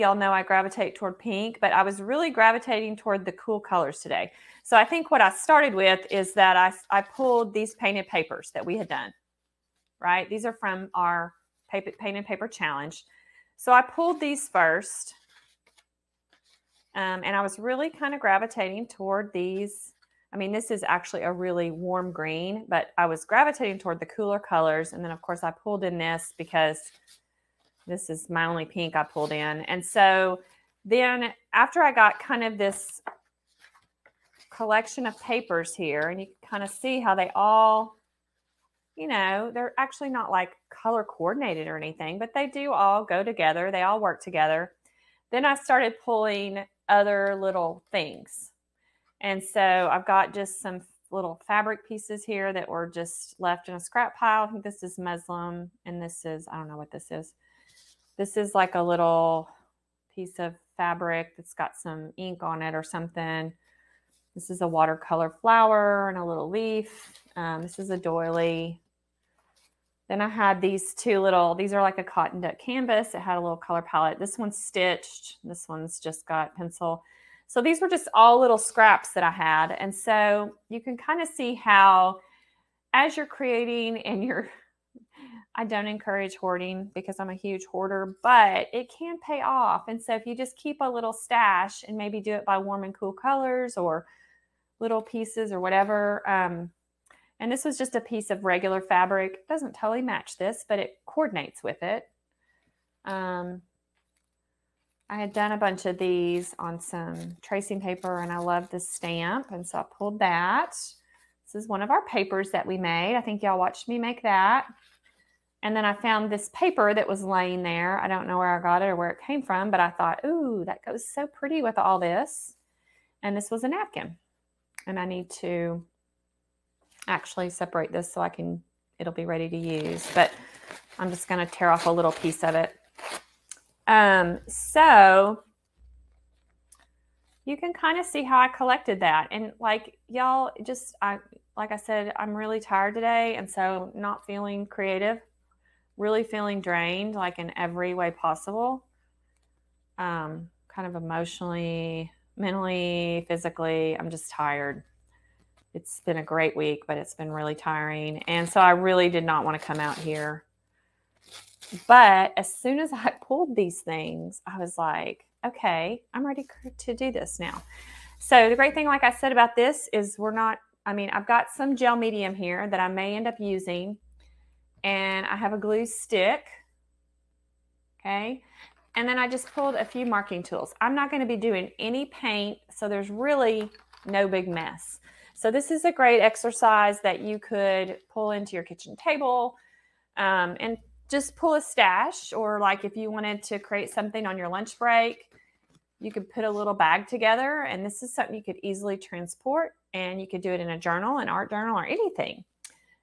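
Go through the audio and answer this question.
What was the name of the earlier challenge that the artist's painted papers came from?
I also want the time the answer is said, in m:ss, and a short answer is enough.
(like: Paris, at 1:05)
paint and paper challenge, at 0:11.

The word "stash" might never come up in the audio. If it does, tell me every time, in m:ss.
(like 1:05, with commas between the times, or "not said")
1:31, 3:11.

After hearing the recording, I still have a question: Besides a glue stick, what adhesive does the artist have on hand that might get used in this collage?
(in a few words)
gel medium.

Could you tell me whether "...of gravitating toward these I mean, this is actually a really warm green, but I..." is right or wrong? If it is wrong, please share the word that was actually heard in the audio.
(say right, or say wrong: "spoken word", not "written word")
right.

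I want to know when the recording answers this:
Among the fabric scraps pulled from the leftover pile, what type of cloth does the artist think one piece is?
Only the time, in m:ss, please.
0:54.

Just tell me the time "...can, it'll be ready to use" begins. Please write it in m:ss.
2:08.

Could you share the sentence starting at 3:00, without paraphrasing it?
I'm not going to be doing any paint, so there's really no big mess.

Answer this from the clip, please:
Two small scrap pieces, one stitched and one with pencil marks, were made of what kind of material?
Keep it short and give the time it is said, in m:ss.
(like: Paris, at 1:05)
cotton duck canvas, at 1:12.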